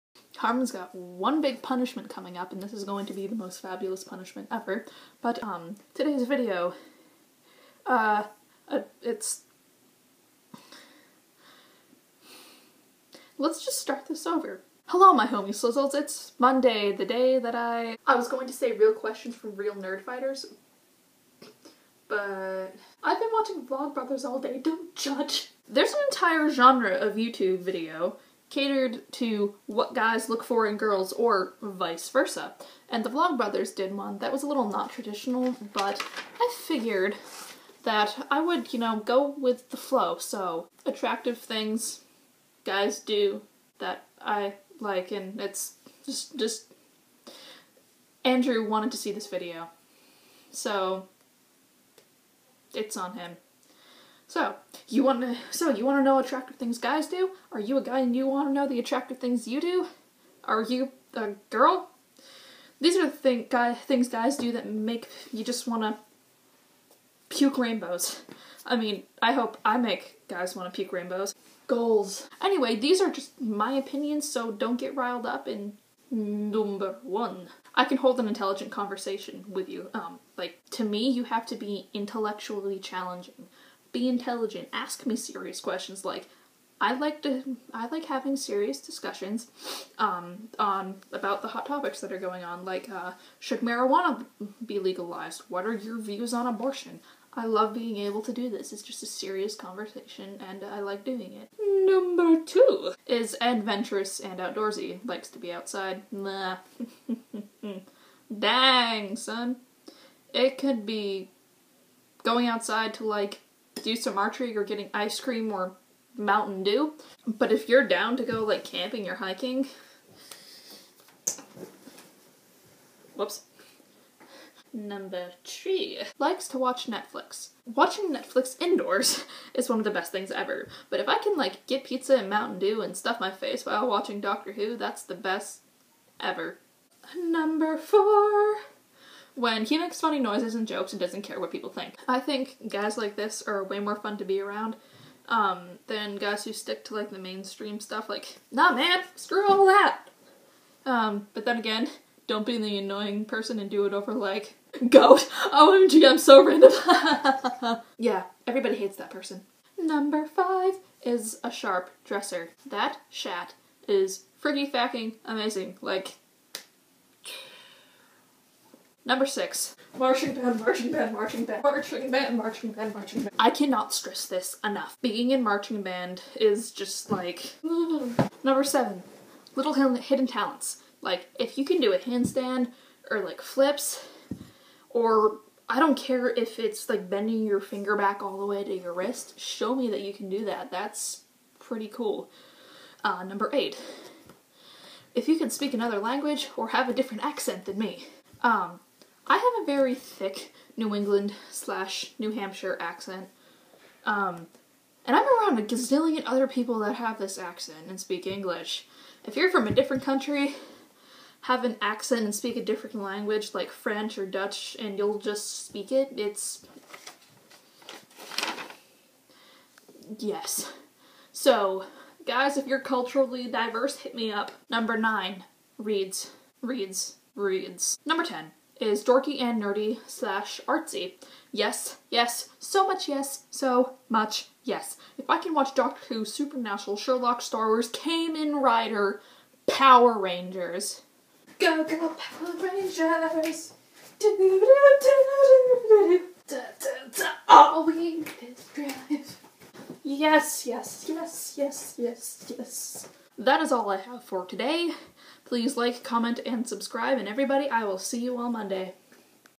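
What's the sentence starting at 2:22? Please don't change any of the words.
I think guys like this are way more fun to be around um, than guys who stick to like the mainstream stuff.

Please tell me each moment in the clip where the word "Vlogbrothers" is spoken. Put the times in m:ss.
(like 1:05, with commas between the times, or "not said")
0:23, 0:33.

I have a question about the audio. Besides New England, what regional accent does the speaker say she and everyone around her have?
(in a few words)
New Hampshire.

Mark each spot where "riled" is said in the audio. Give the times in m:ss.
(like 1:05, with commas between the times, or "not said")
1:14.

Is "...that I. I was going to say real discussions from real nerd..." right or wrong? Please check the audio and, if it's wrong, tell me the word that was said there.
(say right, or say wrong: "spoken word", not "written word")
wrong: "questions", not "discussions".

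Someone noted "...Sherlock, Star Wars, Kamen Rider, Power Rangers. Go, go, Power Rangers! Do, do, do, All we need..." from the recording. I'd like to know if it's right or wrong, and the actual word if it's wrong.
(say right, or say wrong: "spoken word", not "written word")
right.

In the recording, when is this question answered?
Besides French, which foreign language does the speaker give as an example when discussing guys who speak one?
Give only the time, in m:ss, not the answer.
3:34.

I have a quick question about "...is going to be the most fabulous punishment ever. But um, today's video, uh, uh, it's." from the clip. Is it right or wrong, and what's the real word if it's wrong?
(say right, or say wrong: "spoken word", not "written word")
right.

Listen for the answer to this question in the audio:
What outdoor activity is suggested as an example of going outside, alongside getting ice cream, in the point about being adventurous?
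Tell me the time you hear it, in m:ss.
1:54.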